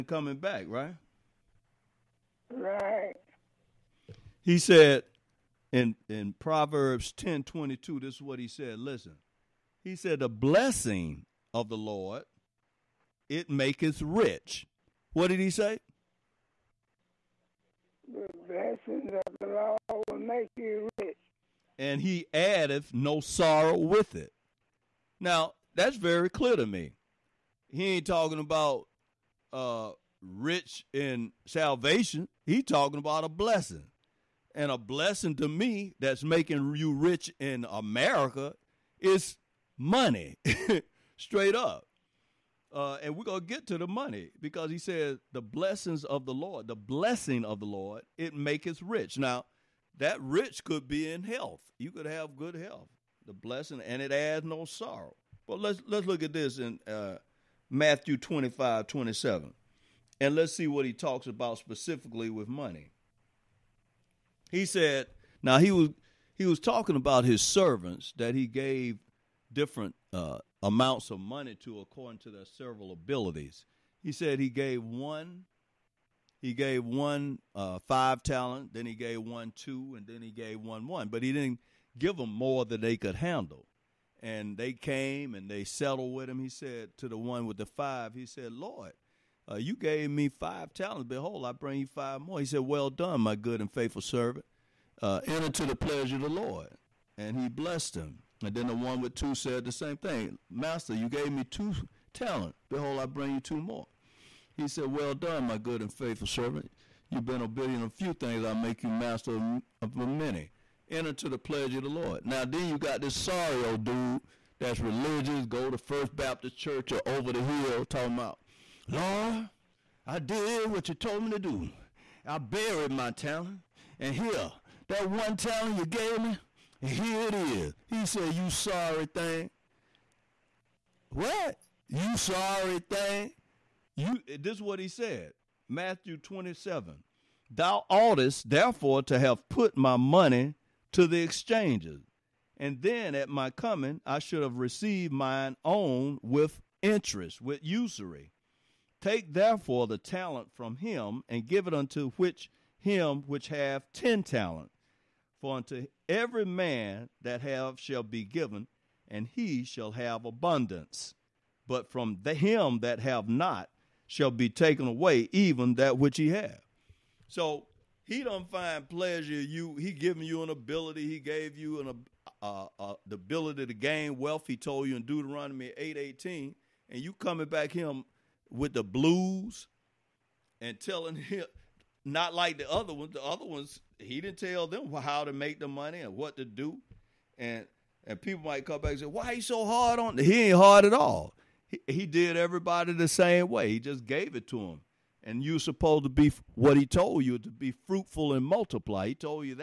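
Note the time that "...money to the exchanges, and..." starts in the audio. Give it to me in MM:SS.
02:19.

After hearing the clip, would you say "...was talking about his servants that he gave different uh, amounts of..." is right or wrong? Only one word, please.
right.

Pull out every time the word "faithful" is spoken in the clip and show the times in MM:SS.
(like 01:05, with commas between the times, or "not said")
01:33, 01:45.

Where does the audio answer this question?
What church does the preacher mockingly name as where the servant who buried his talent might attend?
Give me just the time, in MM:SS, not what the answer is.
01:55.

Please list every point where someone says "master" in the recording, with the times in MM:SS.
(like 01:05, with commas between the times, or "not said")
01:40, 01:48.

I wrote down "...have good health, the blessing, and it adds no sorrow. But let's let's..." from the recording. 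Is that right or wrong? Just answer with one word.
right.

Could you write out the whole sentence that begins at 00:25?
Now, that's very clear to me.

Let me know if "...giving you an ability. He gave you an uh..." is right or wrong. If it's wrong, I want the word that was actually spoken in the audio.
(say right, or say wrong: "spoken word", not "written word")
right.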